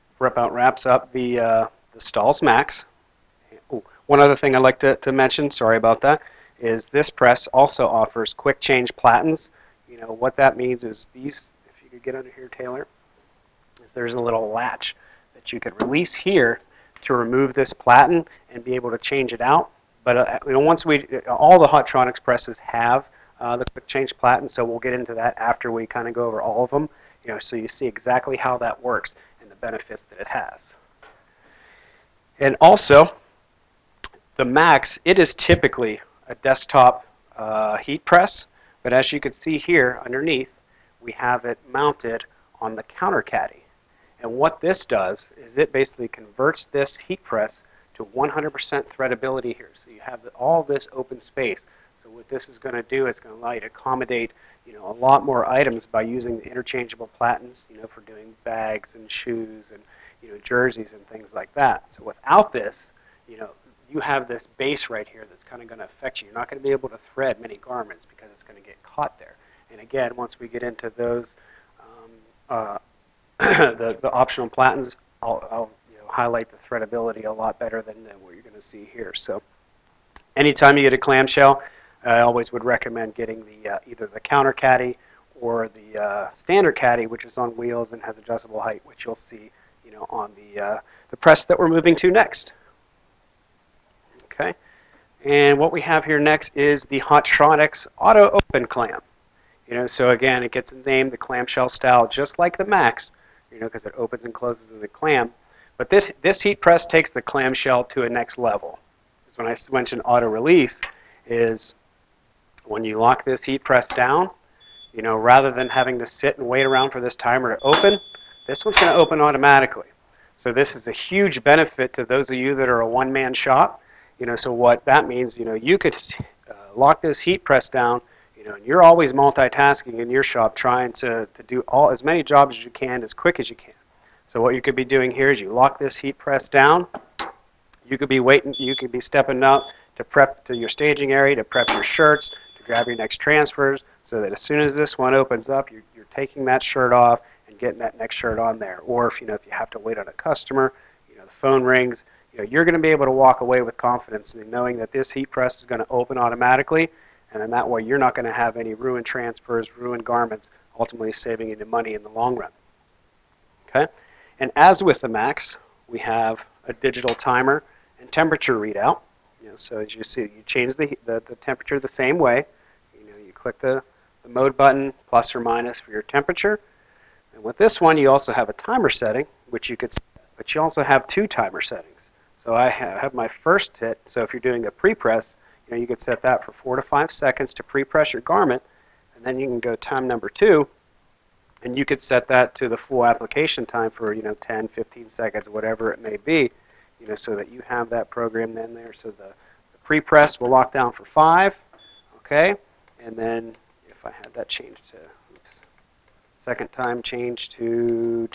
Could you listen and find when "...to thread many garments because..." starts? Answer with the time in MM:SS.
01:06.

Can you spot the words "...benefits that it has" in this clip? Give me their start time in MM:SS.
00:29.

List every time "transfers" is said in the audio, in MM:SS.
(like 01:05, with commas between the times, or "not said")
02:23, 02:39.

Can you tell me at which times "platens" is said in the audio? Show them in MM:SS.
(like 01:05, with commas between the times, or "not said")
00:08, 00:17, 00:24, 00:57, 01:14.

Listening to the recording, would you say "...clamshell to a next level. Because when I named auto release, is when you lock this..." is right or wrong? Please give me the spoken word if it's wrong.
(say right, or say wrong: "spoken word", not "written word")
wrong: "mentioned", not "named".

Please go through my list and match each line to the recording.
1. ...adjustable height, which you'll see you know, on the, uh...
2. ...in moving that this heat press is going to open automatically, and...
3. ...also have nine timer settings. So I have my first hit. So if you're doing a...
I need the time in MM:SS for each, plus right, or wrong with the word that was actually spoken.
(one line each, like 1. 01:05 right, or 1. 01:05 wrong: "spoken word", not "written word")
1. 01:28 right
2. 02:34 wrong: "knowing", not "moving"
3. 03:00 wrong: "two", not "nine".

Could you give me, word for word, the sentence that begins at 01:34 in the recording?
Okay, and what we have here next is the Hotronix Auto Open Clam.